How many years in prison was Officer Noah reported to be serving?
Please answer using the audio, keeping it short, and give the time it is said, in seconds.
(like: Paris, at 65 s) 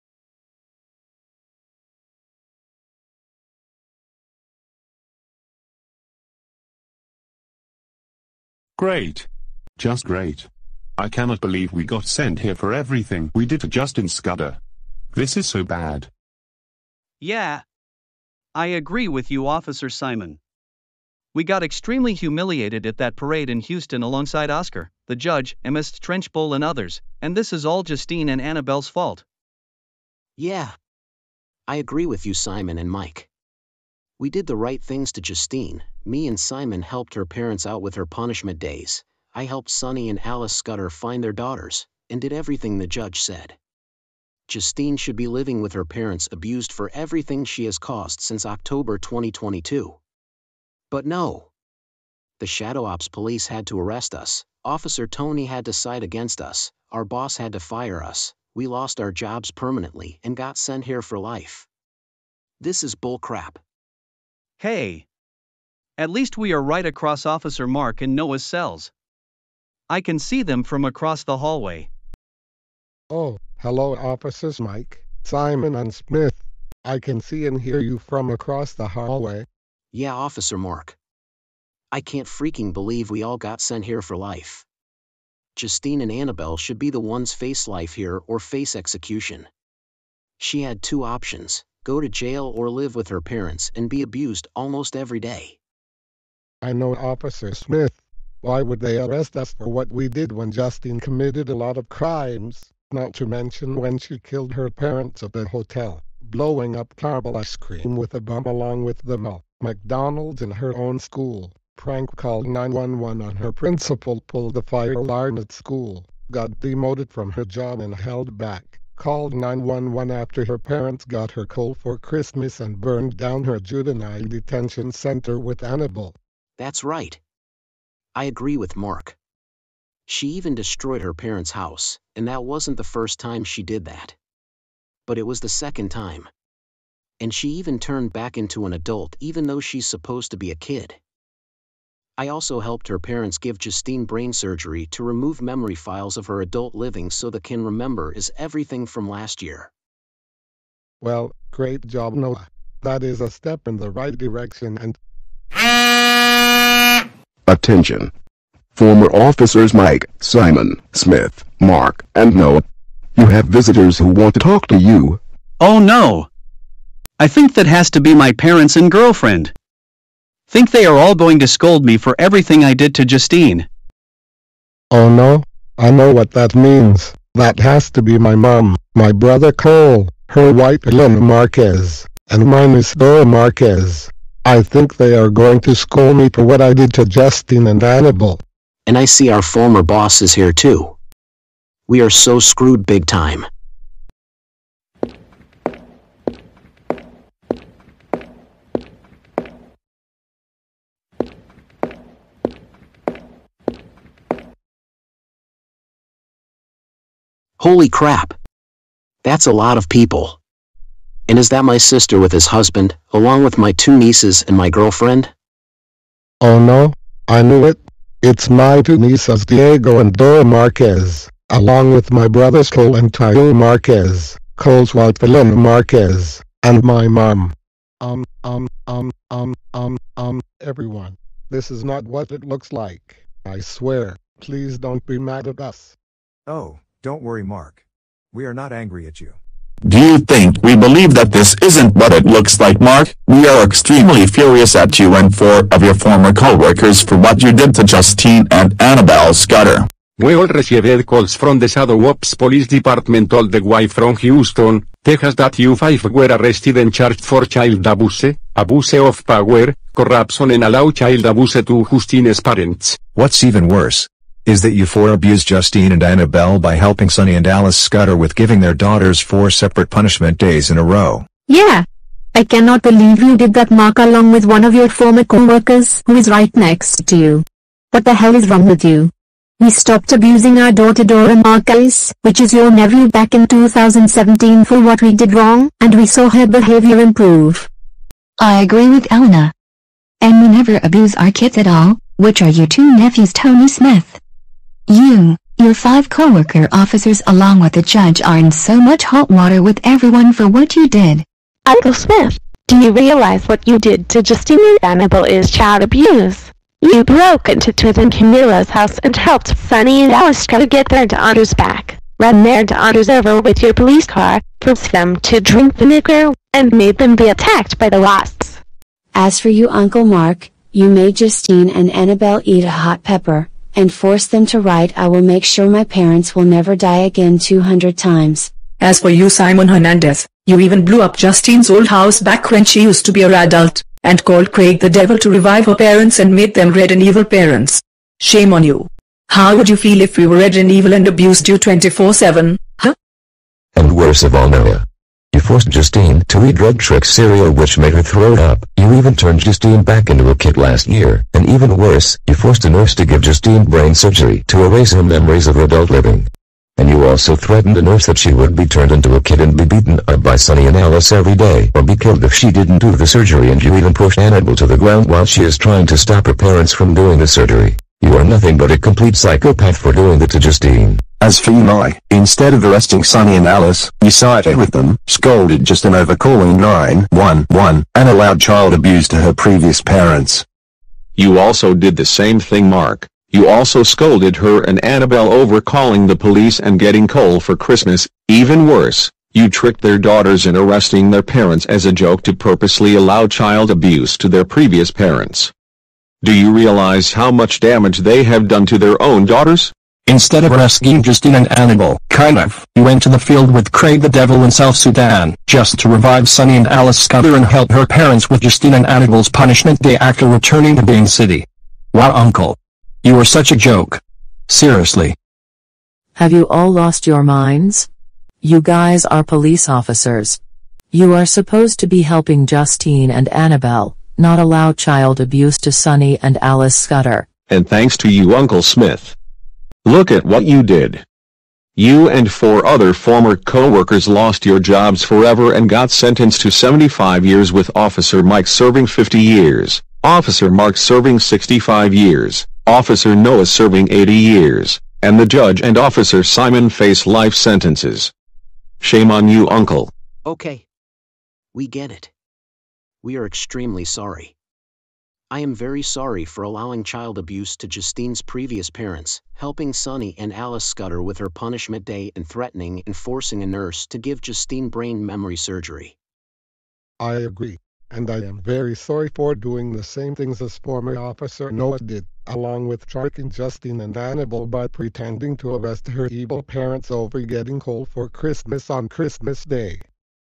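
80, at 443 s.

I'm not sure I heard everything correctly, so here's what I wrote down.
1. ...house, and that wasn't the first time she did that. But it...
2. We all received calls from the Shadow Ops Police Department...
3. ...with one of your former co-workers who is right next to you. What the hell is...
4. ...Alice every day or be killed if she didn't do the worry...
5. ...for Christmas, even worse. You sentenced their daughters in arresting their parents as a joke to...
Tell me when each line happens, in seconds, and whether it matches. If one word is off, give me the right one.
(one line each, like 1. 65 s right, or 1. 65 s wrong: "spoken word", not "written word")
1. 131 s right
2. 250 s right
3. 274 s right
4. 360 s wrong: "surgery", not "worry"
5. 387 s wrong: "tricked", not "sentenced".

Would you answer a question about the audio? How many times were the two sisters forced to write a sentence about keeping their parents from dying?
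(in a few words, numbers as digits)
200.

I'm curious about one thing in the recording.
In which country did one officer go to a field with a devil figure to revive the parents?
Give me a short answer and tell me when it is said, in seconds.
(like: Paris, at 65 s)
South Sudan, at 404 s.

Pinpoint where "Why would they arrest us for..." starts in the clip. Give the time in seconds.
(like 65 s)
98 s.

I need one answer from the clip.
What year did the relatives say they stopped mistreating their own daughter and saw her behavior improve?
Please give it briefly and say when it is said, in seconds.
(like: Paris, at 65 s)
2017, at 283 s.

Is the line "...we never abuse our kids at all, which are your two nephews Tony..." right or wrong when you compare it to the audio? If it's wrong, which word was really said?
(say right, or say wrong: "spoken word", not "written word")
right.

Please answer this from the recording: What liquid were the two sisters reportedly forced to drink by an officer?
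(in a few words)
vinegar.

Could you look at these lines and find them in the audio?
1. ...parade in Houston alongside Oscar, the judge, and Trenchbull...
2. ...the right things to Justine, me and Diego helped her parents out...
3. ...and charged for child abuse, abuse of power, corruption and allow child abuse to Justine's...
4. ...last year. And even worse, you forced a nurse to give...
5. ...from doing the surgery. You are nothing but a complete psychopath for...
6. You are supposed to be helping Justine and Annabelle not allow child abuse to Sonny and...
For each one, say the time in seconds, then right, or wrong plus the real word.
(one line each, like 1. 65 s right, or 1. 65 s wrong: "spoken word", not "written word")
1. 23 s right
2. 34 s wrong: "Simon", not "Diego"
3. 256 s right
4. 350 s right
5. 366 s right
6. 420 s right.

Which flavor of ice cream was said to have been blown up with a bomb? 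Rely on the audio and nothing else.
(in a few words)
caramel.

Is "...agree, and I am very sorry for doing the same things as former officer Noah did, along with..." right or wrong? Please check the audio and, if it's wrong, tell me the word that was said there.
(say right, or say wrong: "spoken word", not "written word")
right.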